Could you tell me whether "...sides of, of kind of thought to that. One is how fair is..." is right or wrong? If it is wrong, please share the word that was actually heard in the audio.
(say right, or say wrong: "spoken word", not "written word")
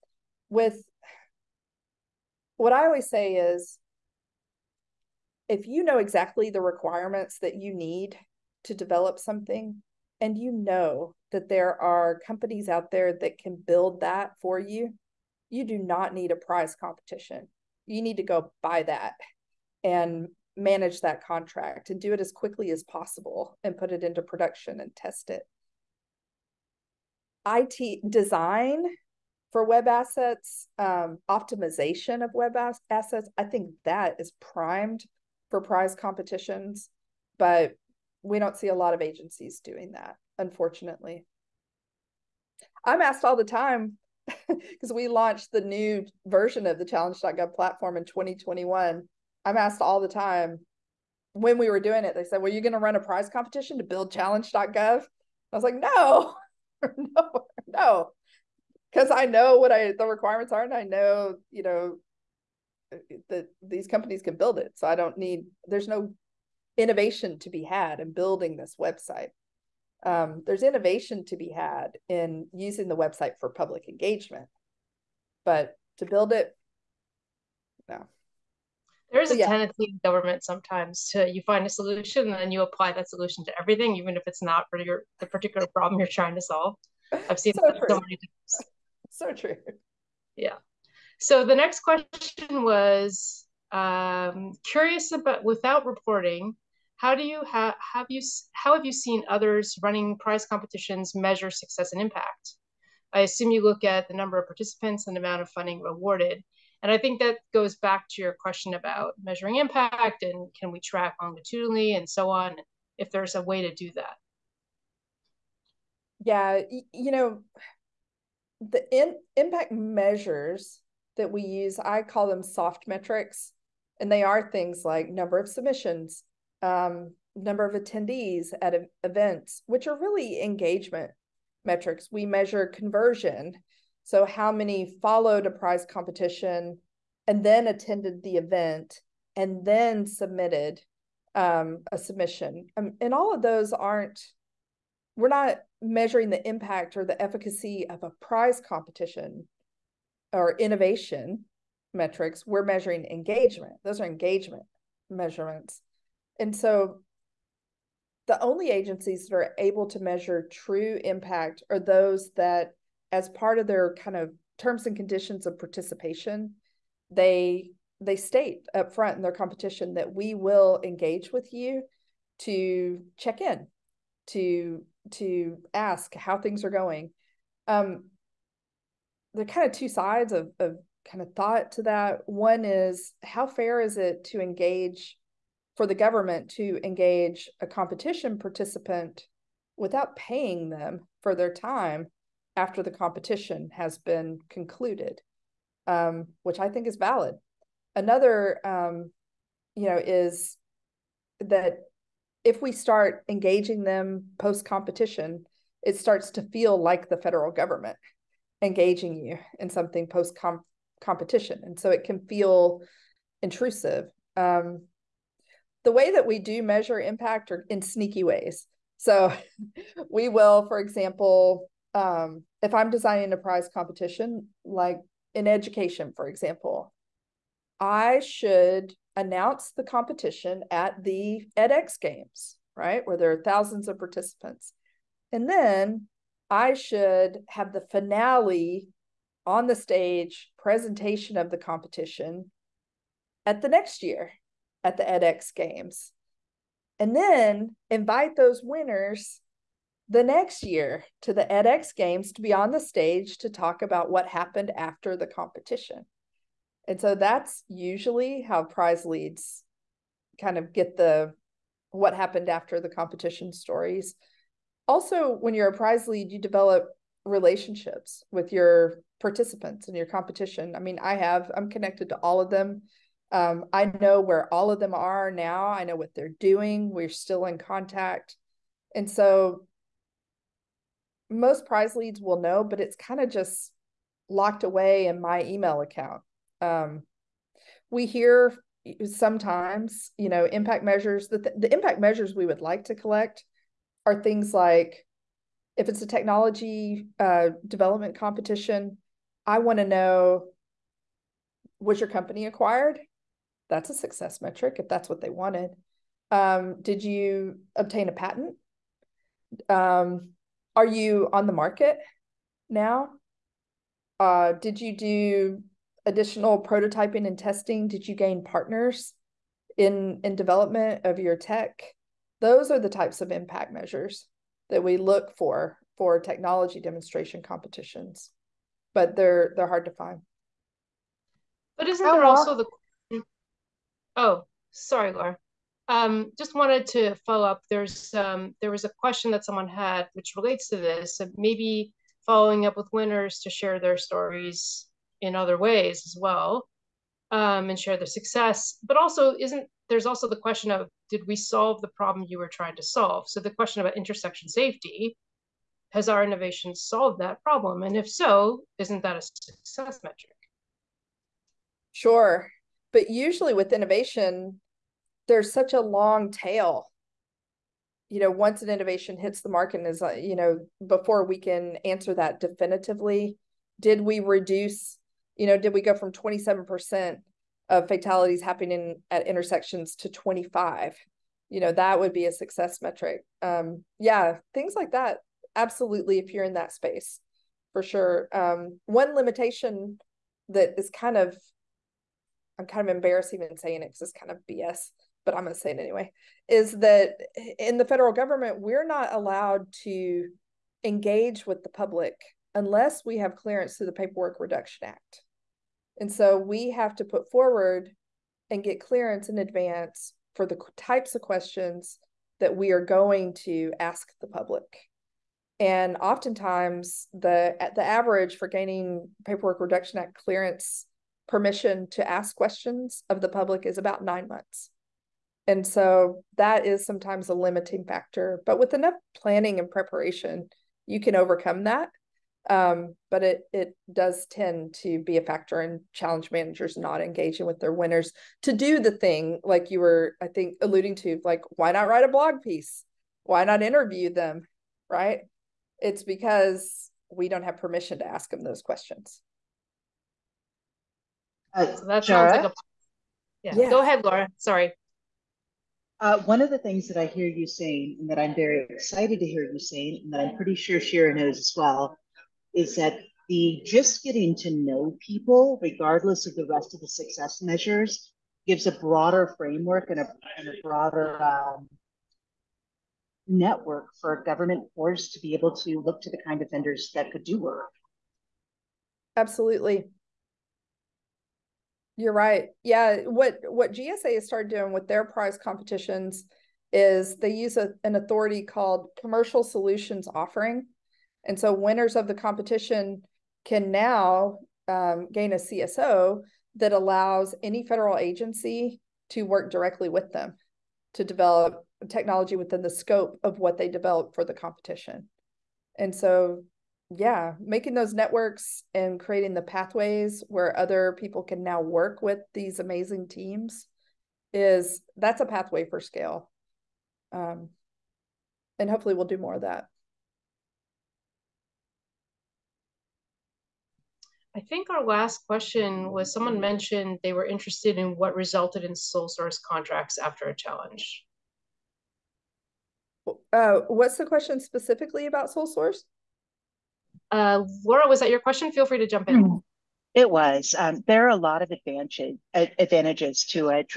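right.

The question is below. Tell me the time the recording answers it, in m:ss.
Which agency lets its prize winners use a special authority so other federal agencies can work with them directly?
8:03.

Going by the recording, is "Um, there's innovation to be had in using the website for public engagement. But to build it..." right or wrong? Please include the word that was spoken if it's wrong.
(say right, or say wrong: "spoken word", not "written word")
right.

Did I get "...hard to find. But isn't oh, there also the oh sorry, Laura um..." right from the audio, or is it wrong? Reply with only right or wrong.
right.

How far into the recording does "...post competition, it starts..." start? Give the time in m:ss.
3:24.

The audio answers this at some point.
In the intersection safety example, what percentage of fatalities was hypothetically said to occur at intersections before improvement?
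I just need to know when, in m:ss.
6:16.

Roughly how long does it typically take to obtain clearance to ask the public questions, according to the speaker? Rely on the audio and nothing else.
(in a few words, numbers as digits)
9 months.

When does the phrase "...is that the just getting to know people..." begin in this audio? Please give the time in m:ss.
7:42.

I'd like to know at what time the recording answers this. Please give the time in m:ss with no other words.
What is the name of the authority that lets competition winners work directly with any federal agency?
8:08.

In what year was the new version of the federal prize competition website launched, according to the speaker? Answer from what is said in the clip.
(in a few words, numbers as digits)
2021.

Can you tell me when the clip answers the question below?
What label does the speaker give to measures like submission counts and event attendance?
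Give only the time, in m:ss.
2:02.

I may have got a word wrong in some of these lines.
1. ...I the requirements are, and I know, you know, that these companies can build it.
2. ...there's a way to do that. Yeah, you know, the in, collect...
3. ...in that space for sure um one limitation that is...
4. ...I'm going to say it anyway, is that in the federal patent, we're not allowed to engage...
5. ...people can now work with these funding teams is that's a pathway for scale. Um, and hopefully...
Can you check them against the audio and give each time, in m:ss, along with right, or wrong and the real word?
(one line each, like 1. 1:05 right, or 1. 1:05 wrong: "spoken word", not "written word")
1. 0:59 right
2. 1:53 wrong: "impact", not "collect"
3. 6:26 right
4. 6:35 wrong: "government", not "patent"
5. 8:30 wrong: "amazing", not "funding".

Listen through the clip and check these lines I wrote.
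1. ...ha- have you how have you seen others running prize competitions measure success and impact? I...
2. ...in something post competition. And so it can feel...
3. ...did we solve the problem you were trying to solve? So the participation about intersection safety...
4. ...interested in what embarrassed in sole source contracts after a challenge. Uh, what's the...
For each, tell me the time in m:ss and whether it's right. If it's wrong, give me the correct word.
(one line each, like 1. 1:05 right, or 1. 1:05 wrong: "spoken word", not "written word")
1. 1:37 right
2. 3:29 right
3. 5:51 wrong: "question", not "participation"
4. 8:47 wrong: "resulted", not "embarrassed".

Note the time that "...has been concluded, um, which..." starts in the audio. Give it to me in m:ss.
3:13.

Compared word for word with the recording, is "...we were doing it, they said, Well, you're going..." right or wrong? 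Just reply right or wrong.
right.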